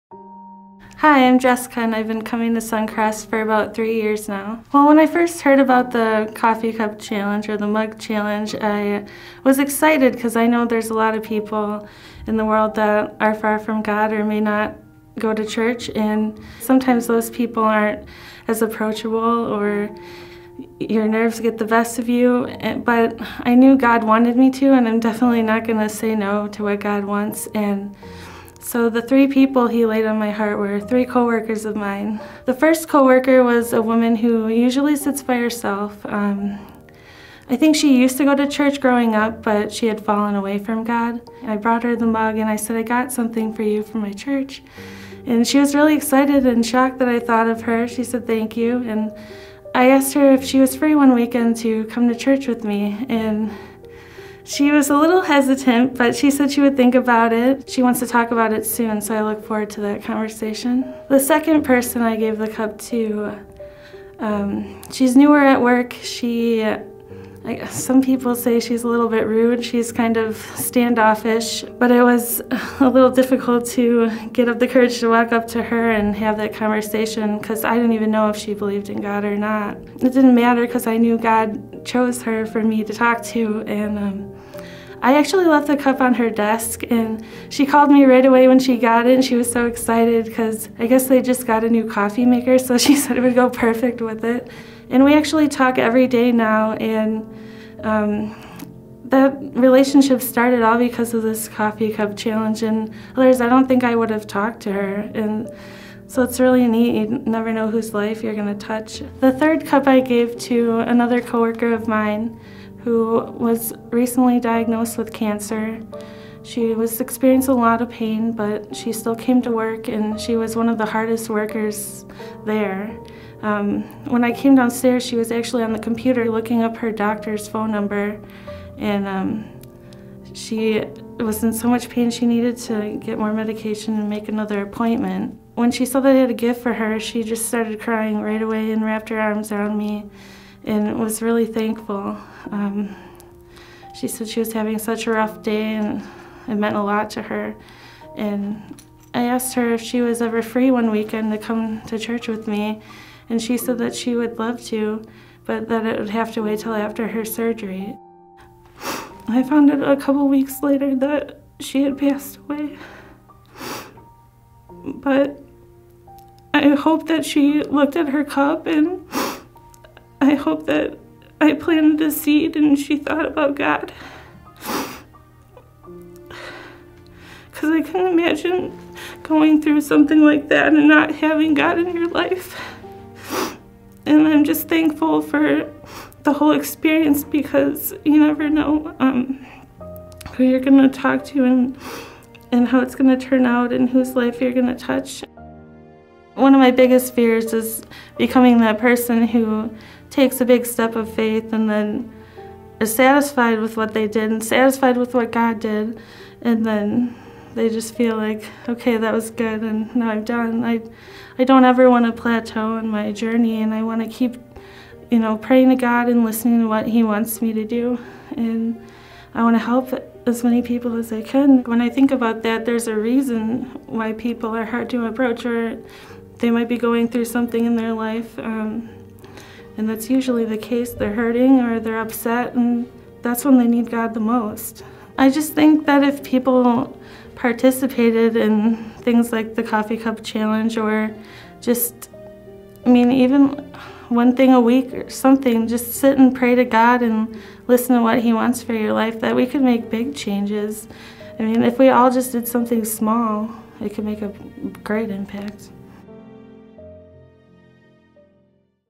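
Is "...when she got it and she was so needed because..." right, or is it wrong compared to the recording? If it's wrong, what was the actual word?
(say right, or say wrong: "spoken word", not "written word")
wrong: "excited", not "needed".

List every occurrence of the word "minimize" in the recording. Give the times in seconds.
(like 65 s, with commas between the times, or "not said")
not said.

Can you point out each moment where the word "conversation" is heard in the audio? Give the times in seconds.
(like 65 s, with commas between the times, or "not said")
60 s, 76 s.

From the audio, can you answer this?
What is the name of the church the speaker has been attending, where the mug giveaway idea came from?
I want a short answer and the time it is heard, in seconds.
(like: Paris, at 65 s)
Suncrest, at 2 s.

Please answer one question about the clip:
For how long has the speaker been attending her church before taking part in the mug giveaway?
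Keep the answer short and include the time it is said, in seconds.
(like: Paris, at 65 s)
3 years, at 3 s.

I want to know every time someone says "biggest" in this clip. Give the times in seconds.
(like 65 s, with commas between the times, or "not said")
196 s.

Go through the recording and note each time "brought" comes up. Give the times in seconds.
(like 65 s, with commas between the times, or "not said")
41 s.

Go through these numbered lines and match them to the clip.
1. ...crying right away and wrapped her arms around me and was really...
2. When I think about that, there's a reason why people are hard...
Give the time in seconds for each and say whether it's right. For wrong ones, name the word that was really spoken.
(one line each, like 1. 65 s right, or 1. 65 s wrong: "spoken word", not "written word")
1. 137 s right
2. 221 s right.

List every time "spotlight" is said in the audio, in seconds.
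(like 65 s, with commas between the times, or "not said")
not said.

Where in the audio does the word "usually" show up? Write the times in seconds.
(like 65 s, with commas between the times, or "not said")
34 s, 230 s.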